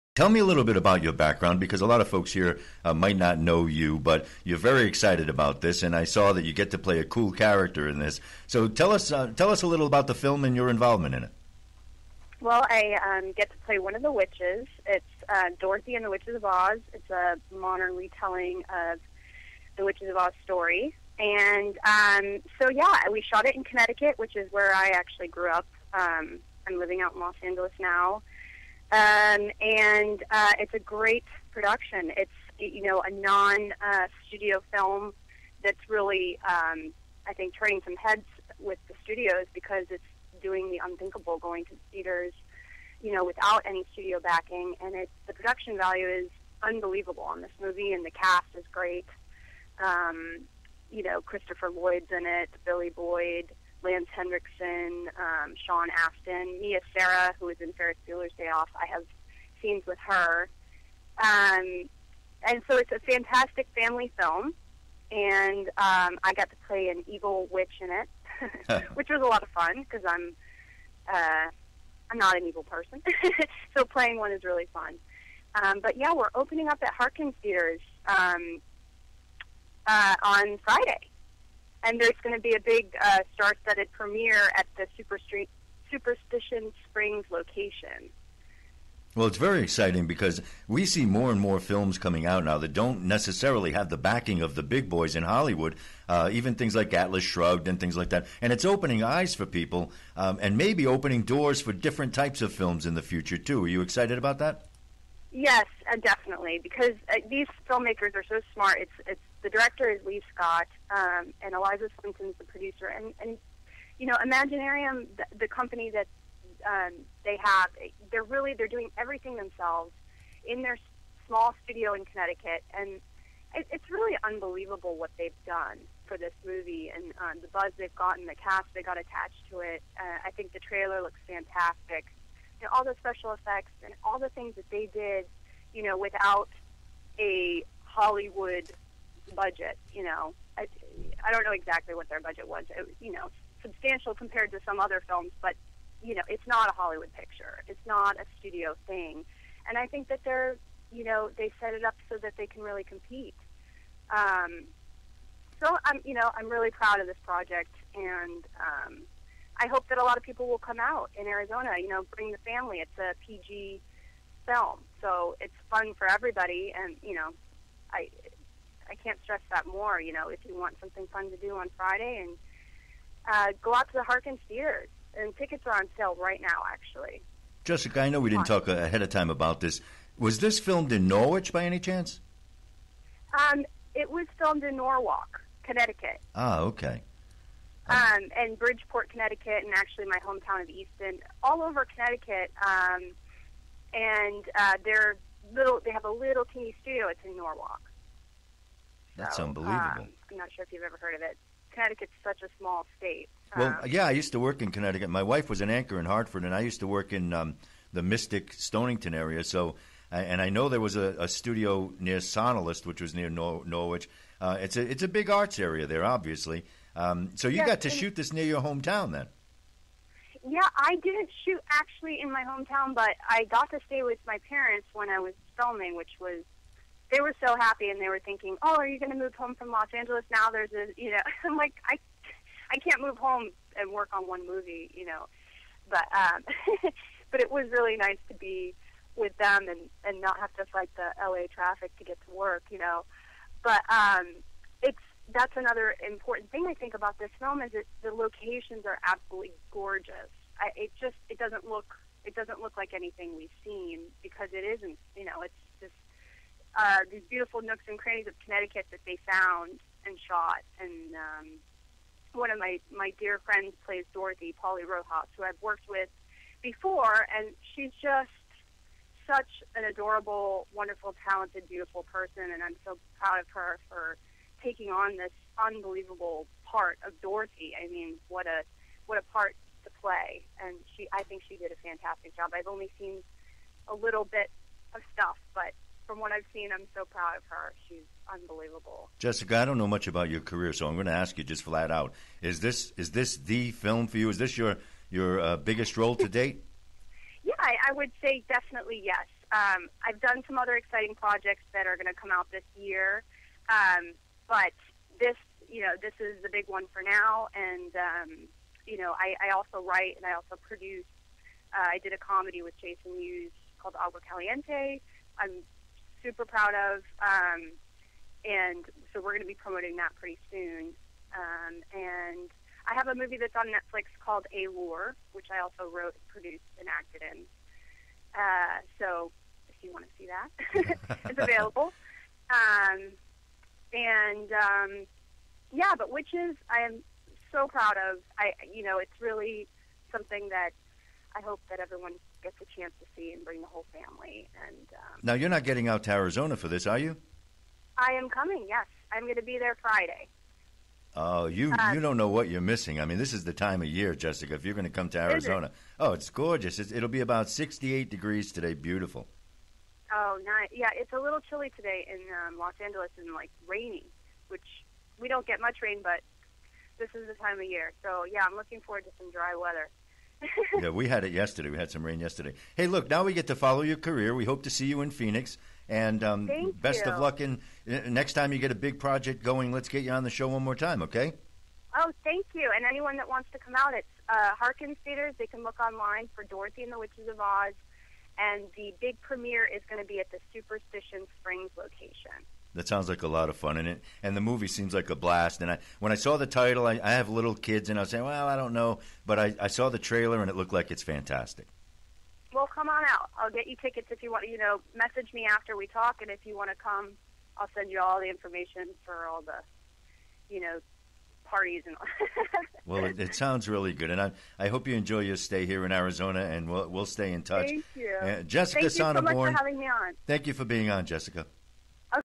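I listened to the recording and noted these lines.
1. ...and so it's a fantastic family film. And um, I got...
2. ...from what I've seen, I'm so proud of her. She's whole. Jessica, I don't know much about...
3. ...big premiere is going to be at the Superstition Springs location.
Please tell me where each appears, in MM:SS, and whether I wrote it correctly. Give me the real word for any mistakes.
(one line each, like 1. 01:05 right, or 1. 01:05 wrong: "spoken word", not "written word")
1. 01:02 right
2. 04:46 wrong: "unbelievable", not "whole"
3. 06:29 right.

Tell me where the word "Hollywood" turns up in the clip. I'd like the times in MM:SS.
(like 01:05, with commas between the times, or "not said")
01:35, 02:17, 02:26.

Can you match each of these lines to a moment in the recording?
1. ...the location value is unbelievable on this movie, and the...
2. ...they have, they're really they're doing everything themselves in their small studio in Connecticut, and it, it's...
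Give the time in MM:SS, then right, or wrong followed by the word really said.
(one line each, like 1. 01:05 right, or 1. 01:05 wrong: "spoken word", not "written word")
1. 00:45 wrong: "production", not "location"
2. 01:57 right.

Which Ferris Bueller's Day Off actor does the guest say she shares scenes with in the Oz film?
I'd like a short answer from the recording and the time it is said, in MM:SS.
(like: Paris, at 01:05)
Mia Sara, at 00:56.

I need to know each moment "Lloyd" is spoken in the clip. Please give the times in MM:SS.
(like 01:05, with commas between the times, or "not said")
00:51.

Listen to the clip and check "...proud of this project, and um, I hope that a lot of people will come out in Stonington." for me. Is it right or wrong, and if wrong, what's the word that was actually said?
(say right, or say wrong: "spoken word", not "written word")
wrong: "Arizona", not "Stonington".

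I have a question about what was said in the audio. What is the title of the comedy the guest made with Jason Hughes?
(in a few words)
Agua Caliente.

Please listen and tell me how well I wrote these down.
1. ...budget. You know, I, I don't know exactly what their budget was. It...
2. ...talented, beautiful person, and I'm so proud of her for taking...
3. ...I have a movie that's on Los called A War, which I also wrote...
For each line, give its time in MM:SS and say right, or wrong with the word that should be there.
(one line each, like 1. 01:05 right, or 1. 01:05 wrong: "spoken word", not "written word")
1. 02:19 right
2. 04:31 right
3. 05:22 wrong: "Netflix", not "Los".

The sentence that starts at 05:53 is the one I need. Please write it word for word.
I mean, this is the time of year, Jessica.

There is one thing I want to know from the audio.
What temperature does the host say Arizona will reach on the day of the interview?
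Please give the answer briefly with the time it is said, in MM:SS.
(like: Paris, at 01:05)
68 degrees, at 05:57.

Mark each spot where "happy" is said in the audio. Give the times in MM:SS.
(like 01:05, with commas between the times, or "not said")
03:47.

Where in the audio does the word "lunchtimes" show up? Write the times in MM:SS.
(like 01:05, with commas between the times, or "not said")
not said.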